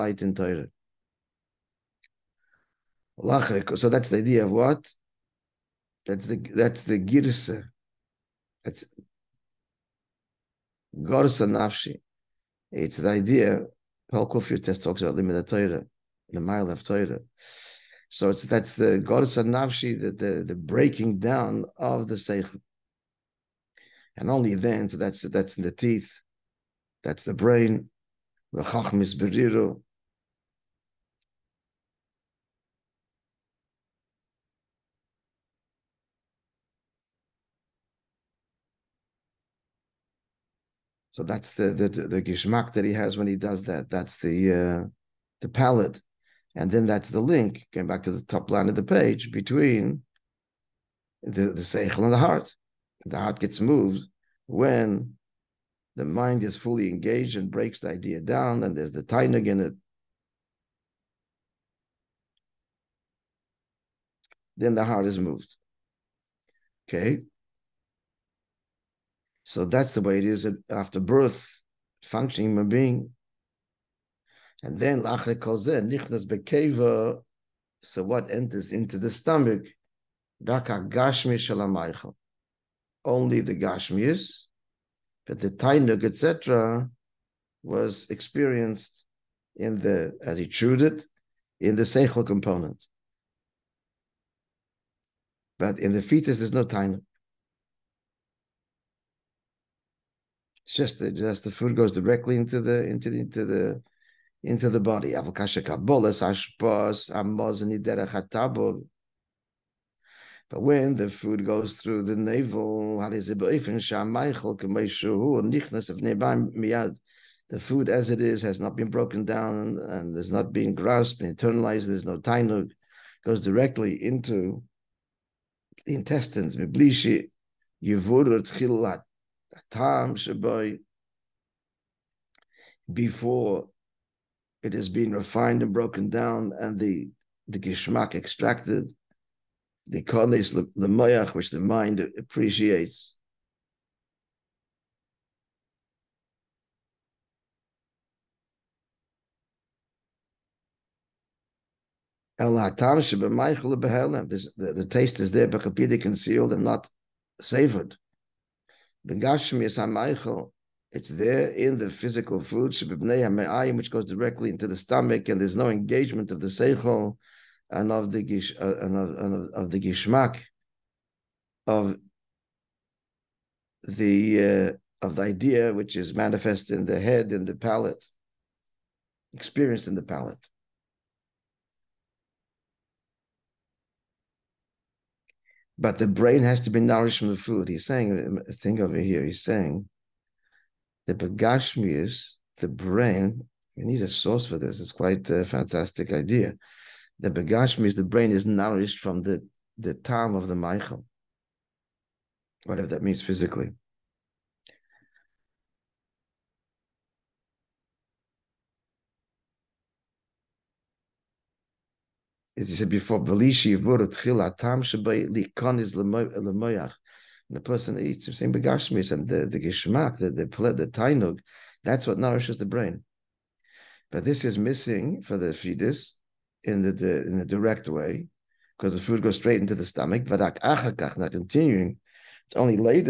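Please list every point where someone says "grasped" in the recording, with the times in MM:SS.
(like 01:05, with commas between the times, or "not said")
02:00.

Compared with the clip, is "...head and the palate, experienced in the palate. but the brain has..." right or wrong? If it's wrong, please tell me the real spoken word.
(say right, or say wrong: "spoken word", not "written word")
right.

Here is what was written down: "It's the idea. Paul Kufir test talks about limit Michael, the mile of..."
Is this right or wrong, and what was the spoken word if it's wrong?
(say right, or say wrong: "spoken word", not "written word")
wrong: "Torah", not "Michael".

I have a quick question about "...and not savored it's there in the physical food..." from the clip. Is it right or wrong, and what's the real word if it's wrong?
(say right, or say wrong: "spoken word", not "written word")
right.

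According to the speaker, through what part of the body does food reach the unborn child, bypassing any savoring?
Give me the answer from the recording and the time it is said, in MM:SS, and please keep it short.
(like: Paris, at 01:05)
The navel, at 01:52.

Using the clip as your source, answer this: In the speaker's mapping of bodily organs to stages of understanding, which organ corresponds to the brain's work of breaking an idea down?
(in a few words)
The teeth.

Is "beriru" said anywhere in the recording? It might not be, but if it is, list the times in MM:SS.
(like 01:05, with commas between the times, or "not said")
00:29.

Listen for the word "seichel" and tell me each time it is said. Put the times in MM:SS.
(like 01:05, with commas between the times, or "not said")
00:22, 00:51, 01:31, 02:46.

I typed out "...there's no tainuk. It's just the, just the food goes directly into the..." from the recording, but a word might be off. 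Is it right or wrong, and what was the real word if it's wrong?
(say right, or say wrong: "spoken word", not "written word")
right.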